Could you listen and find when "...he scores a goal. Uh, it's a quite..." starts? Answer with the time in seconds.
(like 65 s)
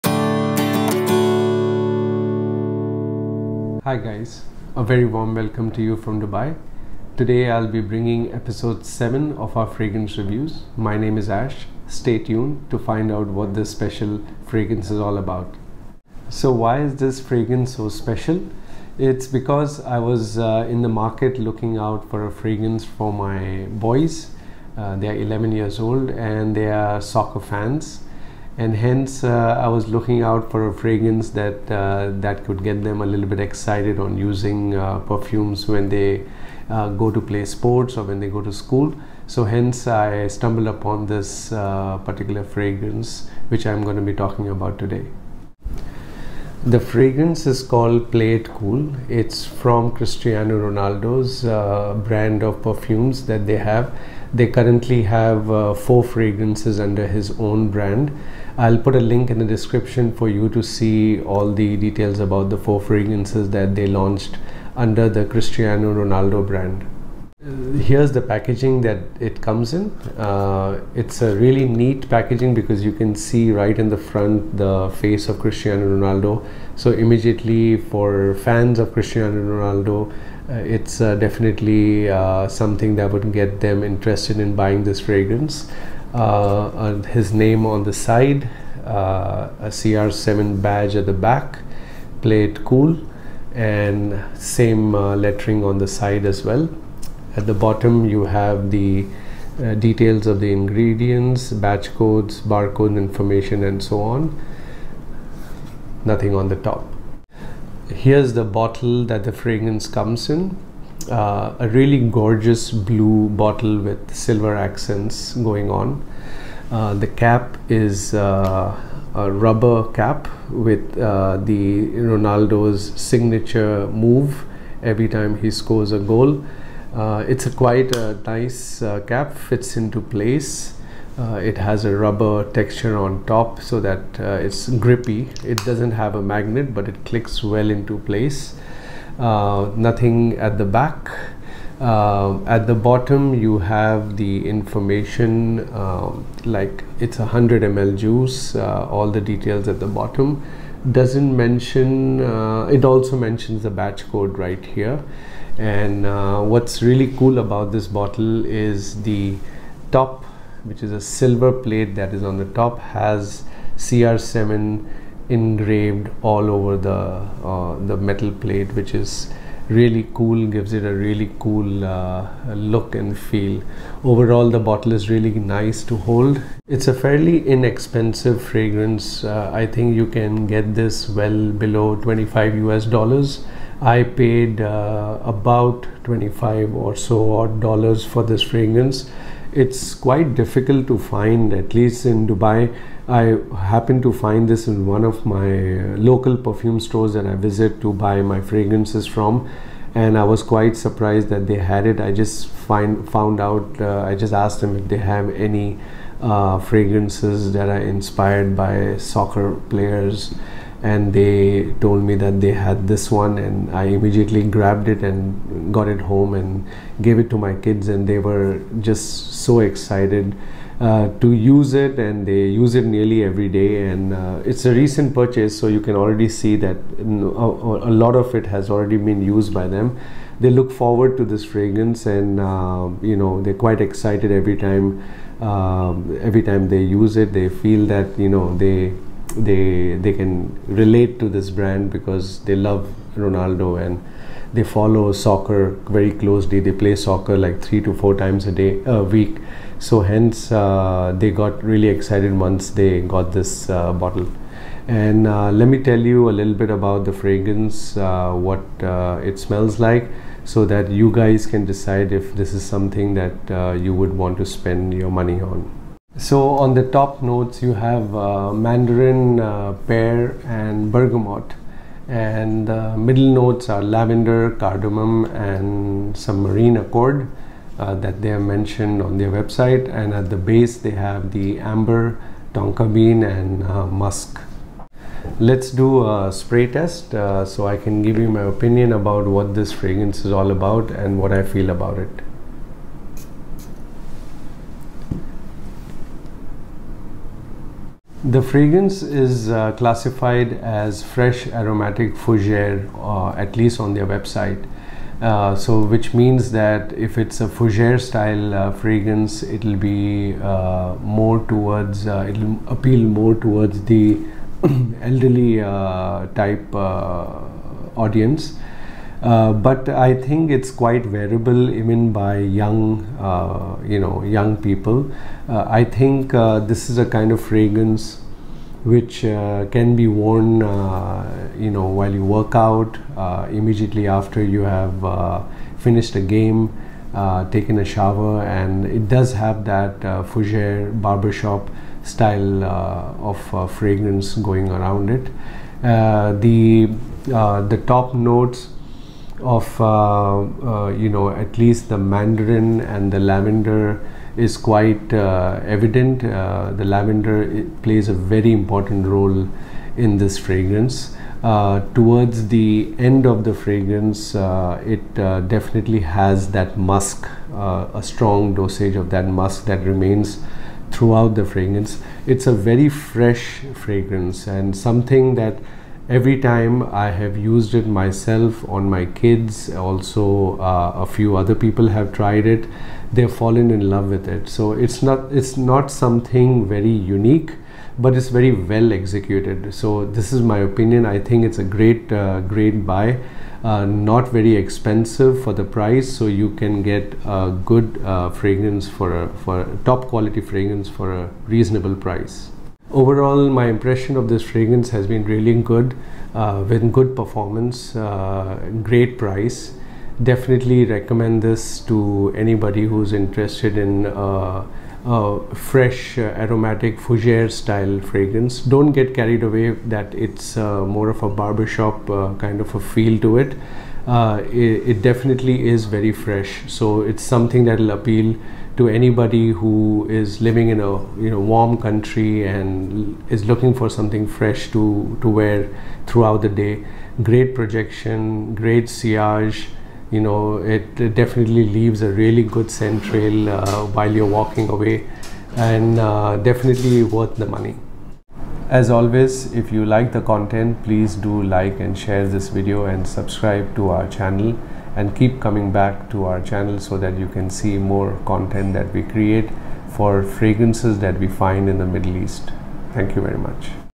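125 s.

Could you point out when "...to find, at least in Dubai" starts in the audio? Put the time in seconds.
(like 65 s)
190 s.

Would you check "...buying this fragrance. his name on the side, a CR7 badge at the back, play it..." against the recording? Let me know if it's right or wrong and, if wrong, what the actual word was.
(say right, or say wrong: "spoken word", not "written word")
right.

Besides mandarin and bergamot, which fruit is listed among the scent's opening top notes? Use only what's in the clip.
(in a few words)
Pear.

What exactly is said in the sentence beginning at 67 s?
Uh, here's the packaging that it comes in.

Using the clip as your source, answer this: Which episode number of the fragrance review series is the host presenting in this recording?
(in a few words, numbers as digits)
7.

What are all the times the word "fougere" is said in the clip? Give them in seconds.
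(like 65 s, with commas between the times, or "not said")
302 s, 307 s, 340 s, 416 s.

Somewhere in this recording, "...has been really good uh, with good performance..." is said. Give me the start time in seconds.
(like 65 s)
404 s.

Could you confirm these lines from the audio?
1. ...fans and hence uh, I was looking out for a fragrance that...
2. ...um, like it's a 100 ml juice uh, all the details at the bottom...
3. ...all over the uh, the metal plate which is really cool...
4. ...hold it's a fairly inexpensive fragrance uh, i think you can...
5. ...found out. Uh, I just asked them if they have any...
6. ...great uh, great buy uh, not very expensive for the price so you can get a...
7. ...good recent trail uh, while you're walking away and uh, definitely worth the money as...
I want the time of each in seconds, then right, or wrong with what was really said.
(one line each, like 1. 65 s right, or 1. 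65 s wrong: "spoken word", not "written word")
1. 27 s right
2. 145 s right
3. 166 s right
4. 175 s right
5. 203 s right
6. 391 s right
7. 442 s wrong: "scent", not "recent".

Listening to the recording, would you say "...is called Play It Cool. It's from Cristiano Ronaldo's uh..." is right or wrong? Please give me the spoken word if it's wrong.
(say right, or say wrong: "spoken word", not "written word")
right.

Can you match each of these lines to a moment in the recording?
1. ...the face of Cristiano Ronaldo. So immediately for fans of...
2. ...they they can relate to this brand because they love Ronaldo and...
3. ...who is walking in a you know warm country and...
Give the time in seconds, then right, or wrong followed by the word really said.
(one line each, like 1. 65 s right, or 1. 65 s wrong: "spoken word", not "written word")
1. 74 s right
2. 239 s right
3. 429 s wrong: "living", not "walking".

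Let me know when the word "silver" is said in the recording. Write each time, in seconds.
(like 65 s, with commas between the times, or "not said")
114 s, 161 s.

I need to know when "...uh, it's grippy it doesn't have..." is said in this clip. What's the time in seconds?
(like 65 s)
134 s.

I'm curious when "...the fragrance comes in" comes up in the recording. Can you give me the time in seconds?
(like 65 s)
109 s.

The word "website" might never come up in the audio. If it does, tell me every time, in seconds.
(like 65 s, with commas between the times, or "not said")
279 s, 304 s.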